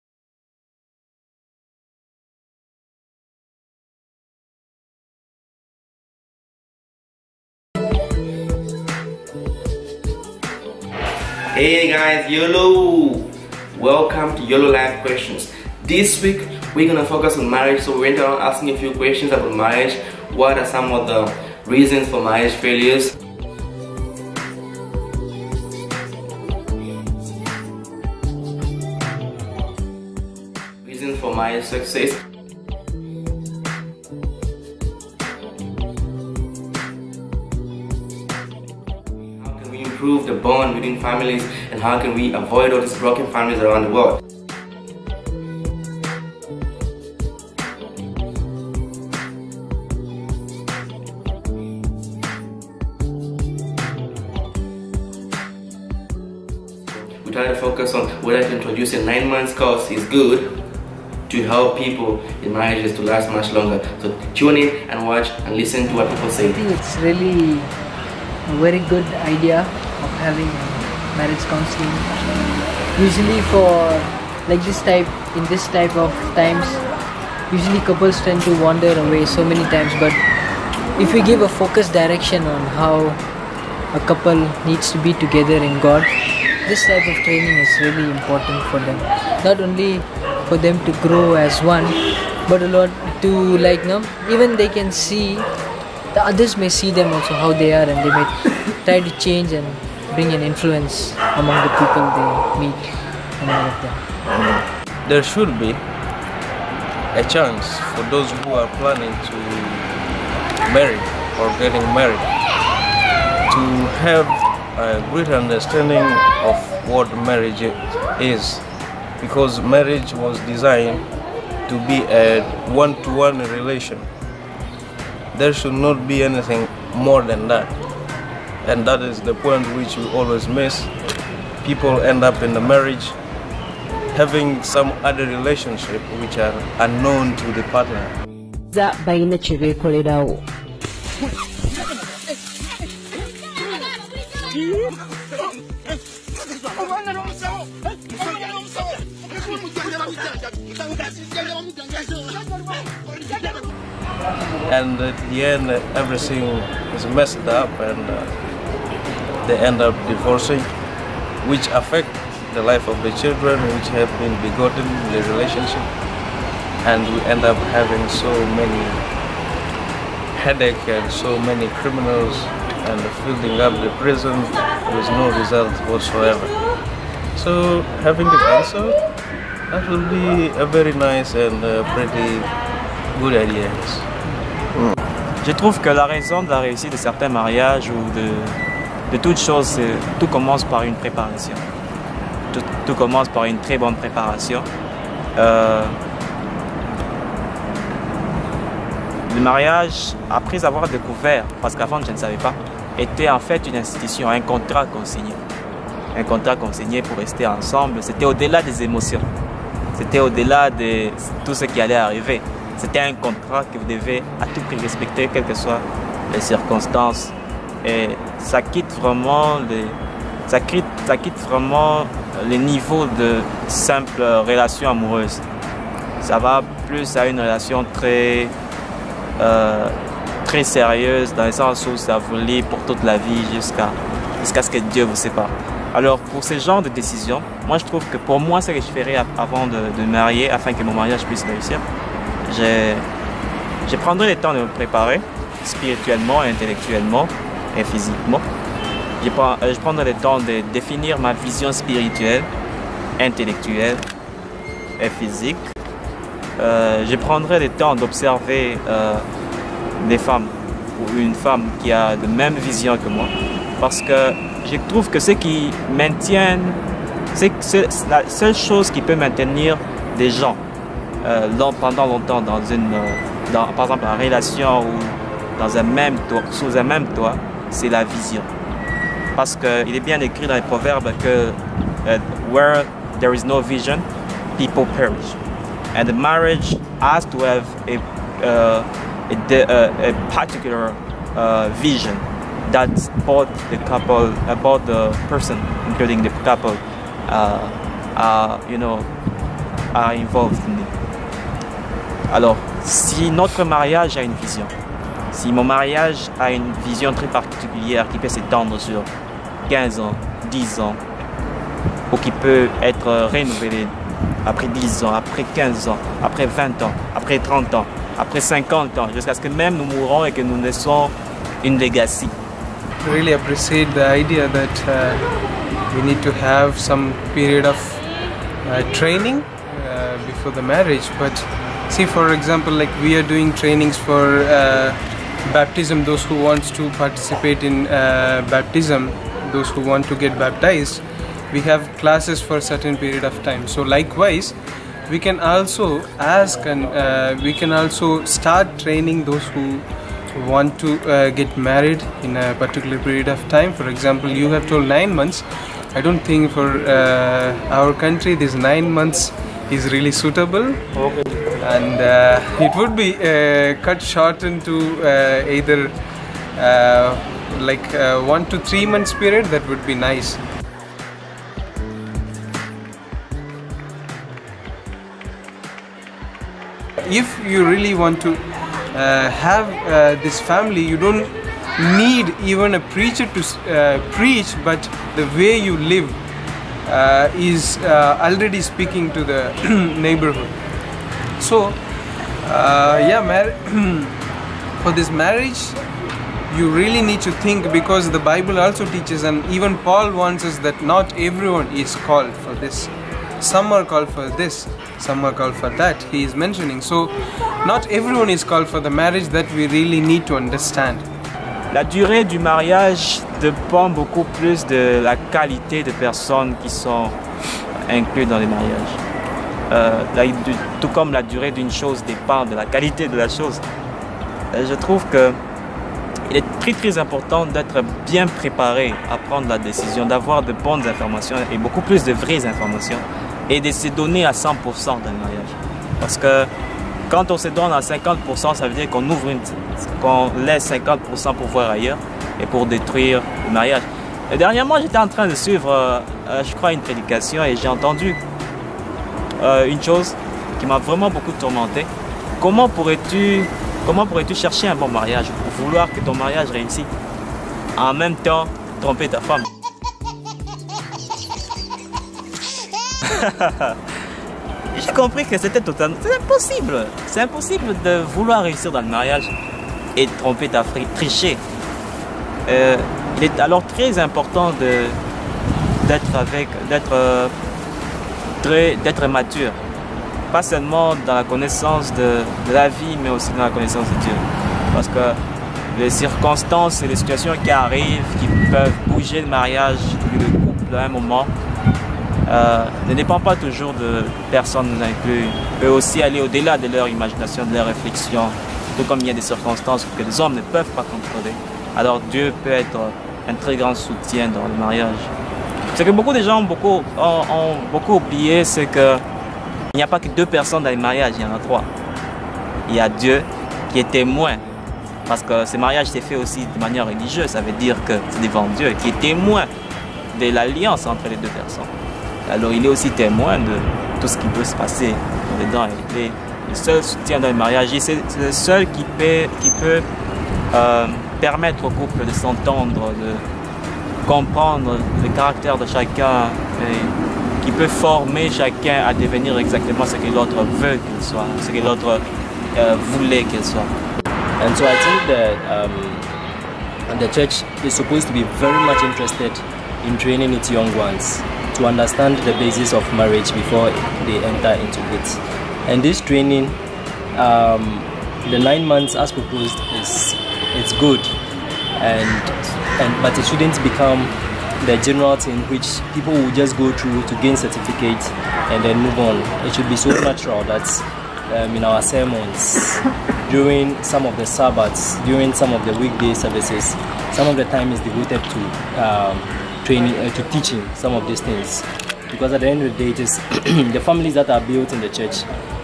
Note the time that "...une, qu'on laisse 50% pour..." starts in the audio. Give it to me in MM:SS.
07:19.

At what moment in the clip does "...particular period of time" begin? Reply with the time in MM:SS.
05:52.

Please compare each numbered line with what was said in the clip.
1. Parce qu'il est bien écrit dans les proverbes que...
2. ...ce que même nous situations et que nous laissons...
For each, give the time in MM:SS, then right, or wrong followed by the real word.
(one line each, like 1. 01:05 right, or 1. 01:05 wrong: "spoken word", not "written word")
1. 04:39 right
2. 05:19 wrong: "mourons", not "situations".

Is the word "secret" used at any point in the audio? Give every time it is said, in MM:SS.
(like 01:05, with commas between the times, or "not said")
not said.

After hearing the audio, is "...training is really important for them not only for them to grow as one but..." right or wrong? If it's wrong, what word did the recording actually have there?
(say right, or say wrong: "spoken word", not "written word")
right.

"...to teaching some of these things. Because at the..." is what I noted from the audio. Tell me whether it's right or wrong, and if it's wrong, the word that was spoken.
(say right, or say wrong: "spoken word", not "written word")
right.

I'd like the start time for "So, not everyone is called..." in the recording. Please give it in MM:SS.
06:46.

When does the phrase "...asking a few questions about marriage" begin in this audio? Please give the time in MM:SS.
00:18.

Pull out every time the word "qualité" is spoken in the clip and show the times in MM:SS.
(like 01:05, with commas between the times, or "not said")
06:55, 07:02.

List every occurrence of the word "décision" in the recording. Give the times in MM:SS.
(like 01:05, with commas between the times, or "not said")
03:56, 07:09.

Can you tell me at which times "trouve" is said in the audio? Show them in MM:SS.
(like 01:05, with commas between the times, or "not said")
03:05, 03:57, 04:24, 07:04.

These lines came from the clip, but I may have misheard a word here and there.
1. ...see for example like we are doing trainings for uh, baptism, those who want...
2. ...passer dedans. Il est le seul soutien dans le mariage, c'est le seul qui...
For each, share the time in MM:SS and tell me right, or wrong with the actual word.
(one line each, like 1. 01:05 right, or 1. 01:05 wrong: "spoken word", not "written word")
1. 05:31 right
2. 08:44 right.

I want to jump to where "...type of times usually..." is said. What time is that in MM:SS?
01:15.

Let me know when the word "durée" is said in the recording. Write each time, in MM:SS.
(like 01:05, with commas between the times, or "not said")
06:51, 07:01.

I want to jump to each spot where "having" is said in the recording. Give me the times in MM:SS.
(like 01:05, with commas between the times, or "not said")
01:10, 02:14, 02:47, 02:58.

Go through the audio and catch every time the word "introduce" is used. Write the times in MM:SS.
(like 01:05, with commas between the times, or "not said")
00:58.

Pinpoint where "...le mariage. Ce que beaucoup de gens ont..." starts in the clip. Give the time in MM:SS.
08:24.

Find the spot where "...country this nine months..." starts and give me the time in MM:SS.
05:57.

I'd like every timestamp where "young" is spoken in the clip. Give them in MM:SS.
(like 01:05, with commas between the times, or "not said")
09:10.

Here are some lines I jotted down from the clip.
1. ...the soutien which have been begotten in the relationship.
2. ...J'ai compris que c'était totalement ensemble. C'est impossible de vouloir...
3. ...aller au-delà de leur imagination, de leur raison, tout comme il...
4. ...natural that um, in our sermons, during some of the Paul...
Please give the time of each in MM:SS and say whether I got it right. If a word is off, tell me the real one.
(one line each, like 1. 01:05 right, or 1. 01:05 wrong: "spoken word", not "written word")
1. 02:43 wrong: "children", not "soutien"
2. 07:44 wrong: "impossible", not "ensemble"
3. 08:16 wrong: "réflexion", not "raison"
4. 09:30 wrong: "Sabbaths", not "Paul".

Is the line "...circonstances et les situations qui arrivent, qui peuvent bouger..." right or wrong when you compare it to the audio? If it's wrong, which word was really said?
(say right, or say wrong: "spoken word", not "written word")
right.